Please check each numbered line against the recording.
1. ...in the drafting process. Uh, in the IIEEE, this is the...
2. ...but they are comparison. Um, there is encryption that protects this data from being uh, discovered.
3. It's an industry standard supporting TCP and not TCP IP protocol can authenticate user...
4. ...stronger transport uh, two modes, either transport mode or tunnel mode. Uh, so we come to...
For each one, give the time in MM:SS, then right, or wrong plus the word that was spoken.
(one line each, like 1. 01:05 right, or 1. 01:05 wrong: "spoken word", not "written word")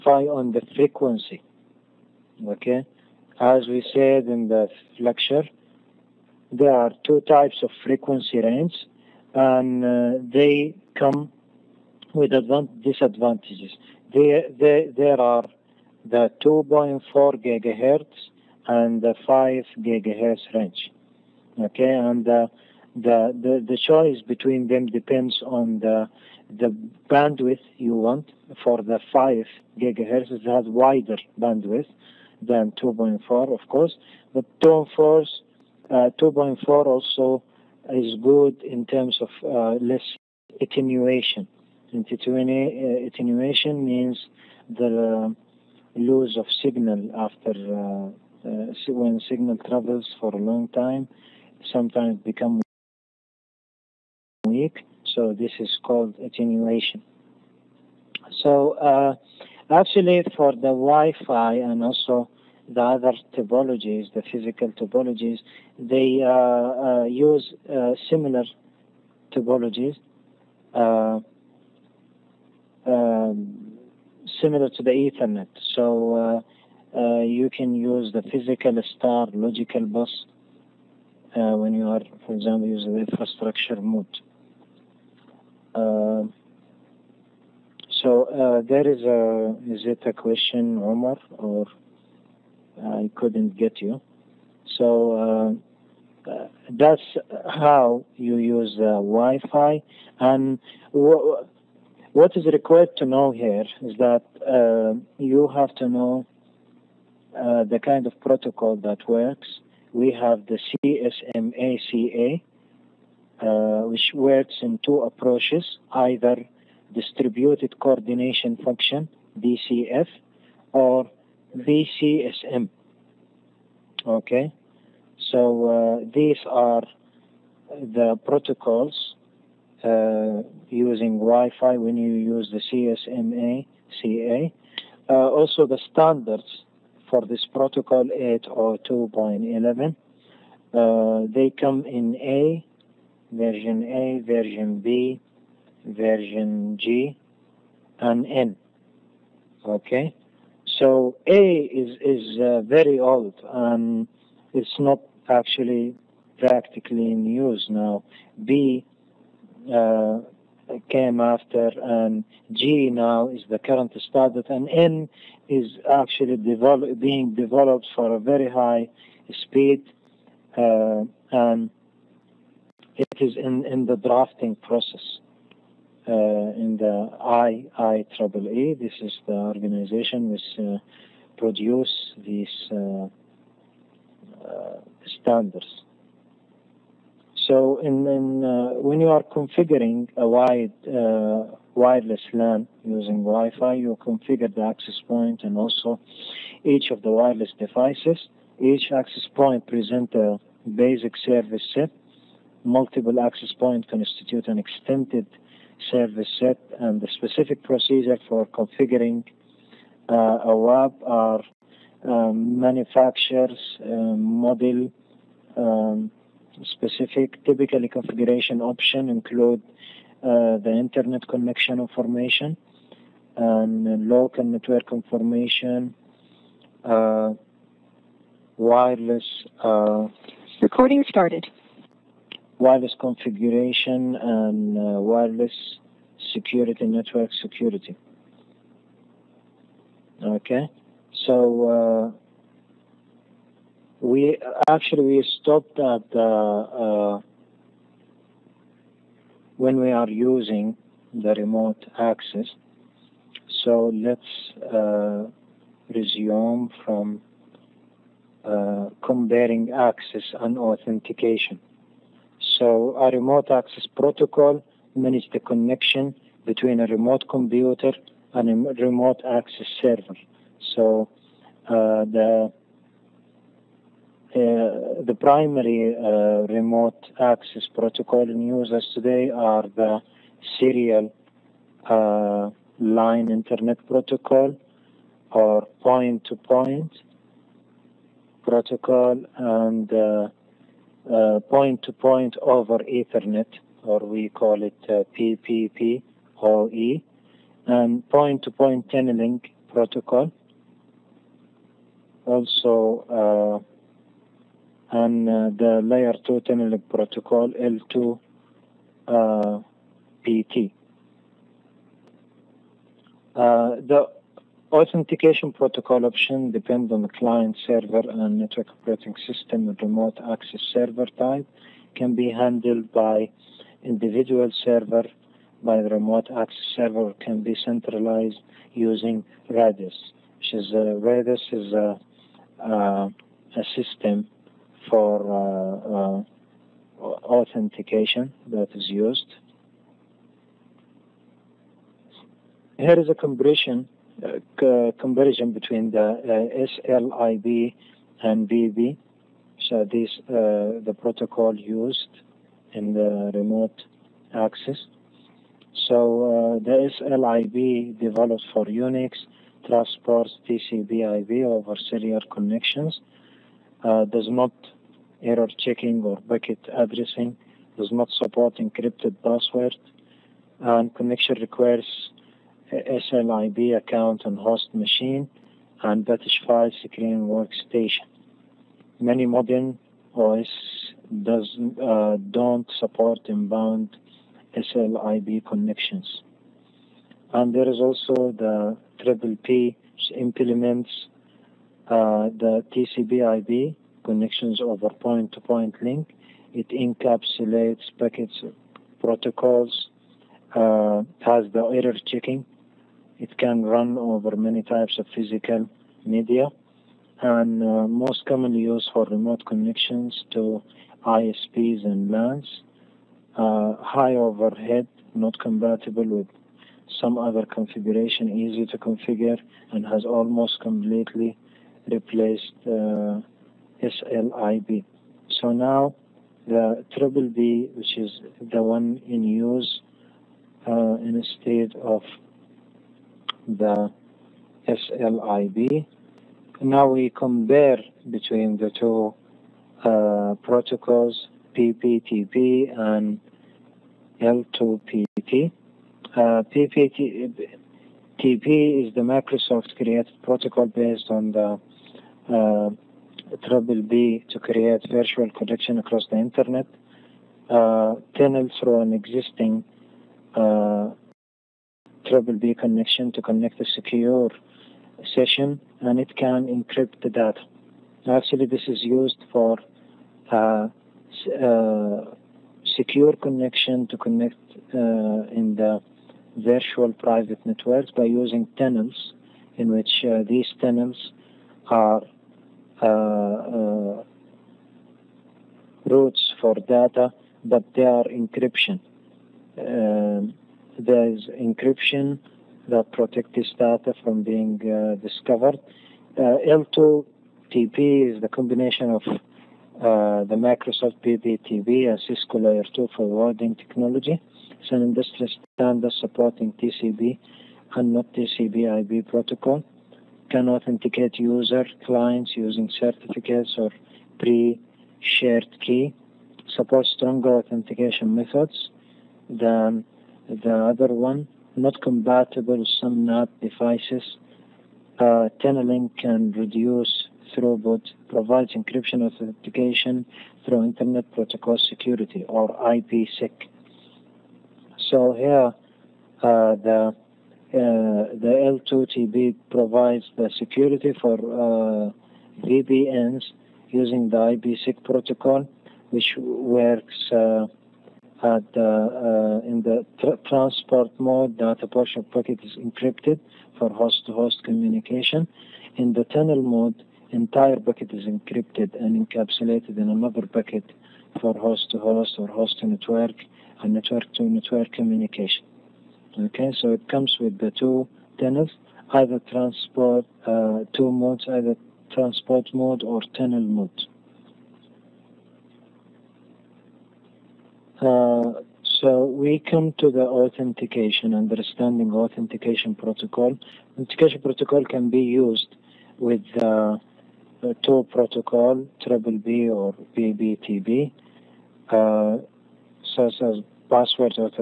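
1. 02:53 right
2. 08:07 wrong: "encryption", not "comparison"
3. 08:24 right
4. 09:28 wrong: "either", not "stronger".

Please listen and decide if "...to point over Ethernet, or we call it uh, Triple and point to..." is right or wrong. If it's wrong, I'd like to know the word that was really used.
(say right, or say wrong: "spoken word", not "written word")
wrong: "PPP", not "Triple".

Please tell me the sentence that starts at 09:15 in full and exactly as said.
In the tunnel mode, entire packet is encrypted and encapsulated in another packet for host-to-host -host or host-to-network and network-to-network -network communication.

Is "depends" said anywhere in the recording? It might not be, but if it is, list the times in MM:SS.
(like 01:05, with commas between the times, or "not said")
00:24, 05:16.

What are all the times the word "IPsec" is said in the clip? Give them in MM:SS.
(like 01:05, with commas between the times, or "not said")
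08:52, 09:04.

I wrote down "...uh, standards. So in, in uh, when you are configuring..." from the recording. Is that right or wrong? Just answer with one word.
right.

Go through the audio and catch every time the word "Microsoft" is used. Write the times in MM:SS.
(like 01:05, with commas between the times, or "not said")
07:29, 08:20.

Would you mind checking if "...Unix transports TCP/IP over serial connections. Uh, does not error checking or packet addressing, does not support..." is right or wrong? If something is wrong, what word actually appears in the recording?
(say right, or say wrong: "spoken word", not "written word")
right.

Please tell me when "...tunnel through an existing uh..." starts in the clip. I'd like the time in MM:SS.
07:38.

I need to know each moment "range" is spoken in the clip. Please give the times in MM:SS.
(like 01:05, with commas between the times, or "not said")
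00:08, 00:20.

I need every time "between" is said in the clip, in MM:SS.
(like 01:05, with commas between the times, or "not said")
00:24, 04:26, 05:45, 07:18.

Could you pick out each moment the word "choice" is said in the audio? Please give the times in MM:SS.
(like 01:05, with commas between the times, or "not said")
00:23.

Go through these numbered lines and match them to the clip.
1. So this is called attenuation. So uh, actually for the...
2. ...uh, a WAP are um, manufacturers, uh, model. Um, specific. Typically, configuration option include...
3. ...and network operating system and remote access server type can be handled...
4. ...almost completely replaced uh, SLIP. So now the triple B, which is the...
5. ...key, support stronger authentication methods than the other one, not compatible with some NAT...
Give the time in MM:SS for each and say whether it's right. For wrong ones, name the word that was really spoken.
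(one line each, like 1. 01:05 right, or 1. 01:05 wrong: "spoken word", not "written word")
1. 00:55 right
2. 03:30 right
3. 05:18 right
4. 07:00 right
5. 08:35 right.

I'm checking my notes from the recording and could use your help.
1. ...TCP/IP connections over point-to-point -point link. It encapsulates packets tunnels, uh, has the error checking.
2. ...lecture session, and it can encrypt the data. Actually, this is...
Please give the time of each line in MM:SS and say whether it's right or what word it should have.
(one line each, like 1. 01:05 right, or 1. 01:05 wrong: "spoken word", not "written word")
1. 06:32 wrong: "protocols", not "tunnels"
2. 07:43 wrong: "secure", not "lecture".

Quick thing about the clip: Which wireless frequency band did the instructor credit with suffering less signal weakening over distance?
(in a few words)
2.4 gigahertz.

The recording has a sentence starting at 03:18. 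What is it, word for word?
Each access point present a basic service set.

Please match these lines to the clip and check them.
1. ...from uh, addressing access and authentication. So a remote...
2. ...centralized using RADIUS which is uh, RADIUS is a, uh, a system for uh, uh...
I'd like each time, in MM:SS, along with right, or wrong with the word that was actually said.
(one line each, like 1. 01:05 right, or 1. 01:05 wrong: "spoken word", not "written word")
1. 04:16 wrong: "comparing", not "addressing"
2. 05:27 right.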